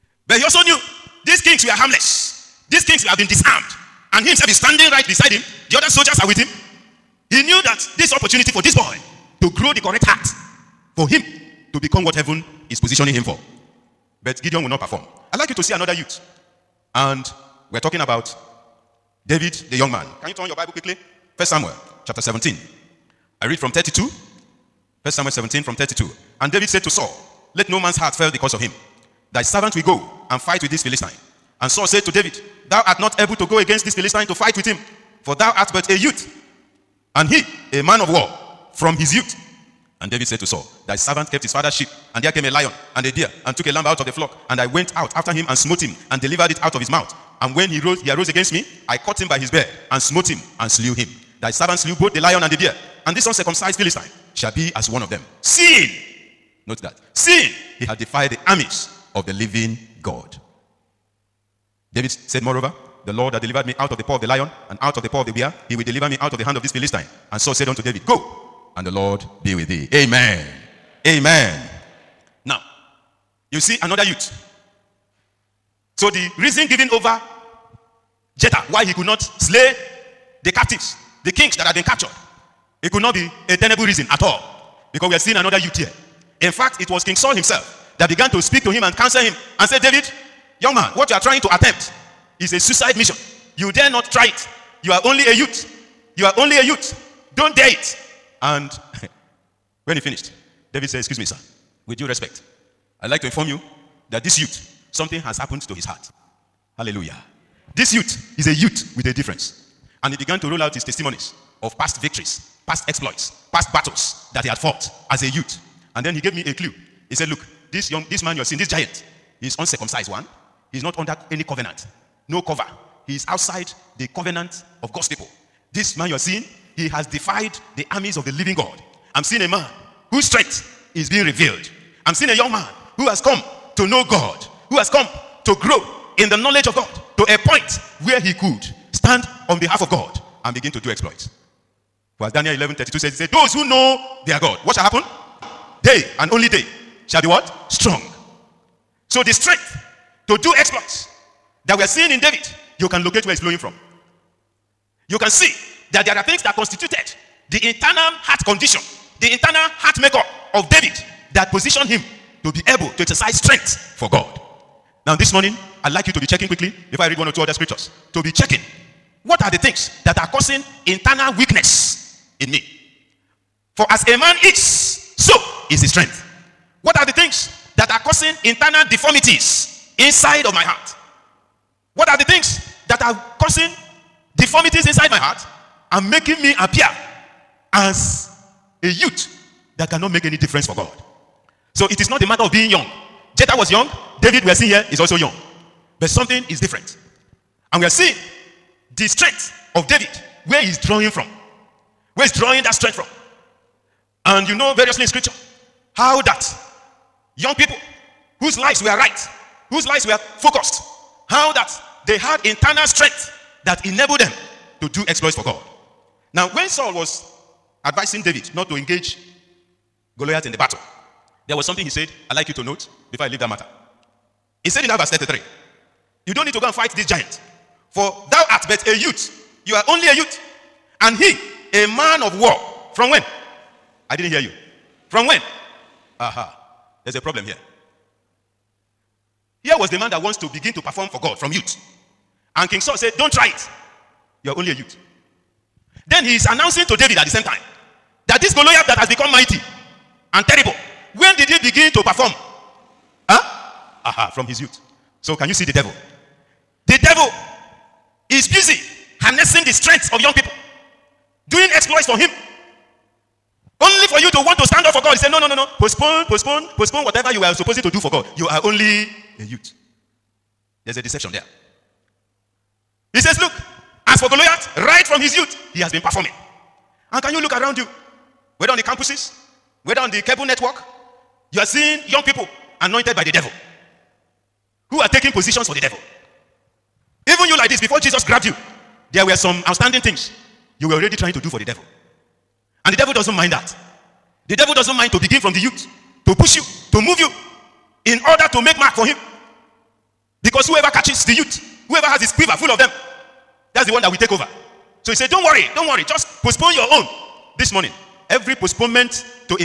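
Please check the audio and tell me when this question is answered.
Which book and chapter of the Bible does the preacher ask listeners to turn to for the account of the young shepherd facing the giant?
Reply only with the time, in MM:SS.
00:21.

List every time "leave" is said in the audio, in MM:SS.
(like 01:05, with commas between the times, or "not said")
03:43.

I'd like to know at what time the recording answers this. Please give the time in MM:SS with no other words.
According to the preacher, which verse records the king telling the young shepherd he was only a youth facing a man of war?
03:44.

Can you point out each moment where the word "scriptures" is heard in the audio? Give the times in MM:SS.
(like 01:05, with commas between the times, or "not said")
02:47, 03:25.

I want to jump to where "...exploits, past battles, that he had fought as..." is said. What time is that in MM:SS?
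01:52.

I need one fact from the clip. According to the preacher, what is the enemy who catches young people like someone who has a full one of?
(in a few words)
His quiver.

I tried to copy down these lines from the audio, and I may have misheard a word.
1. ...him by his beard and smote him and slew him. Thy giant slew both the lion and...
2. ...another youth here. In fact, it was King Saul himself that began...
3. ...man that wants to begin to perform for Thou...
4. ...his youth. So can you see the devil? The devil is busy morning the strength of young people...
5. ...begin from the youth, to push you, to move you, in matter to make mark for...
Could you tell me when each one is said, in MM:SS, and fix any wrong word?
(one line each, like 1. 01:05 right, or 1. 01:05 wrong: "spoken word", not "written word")
1. 00:49 wrong: "servant", not "giant"
2. 01:25 right
3. 03:59 wrong: "God", not "Thou"
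4. 04:14 wrong: "harnessing", not "morning"
5. 04:55 wrong: "order", not "matter".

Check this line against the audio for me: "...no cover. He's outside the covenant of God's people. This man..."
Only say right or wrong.
right.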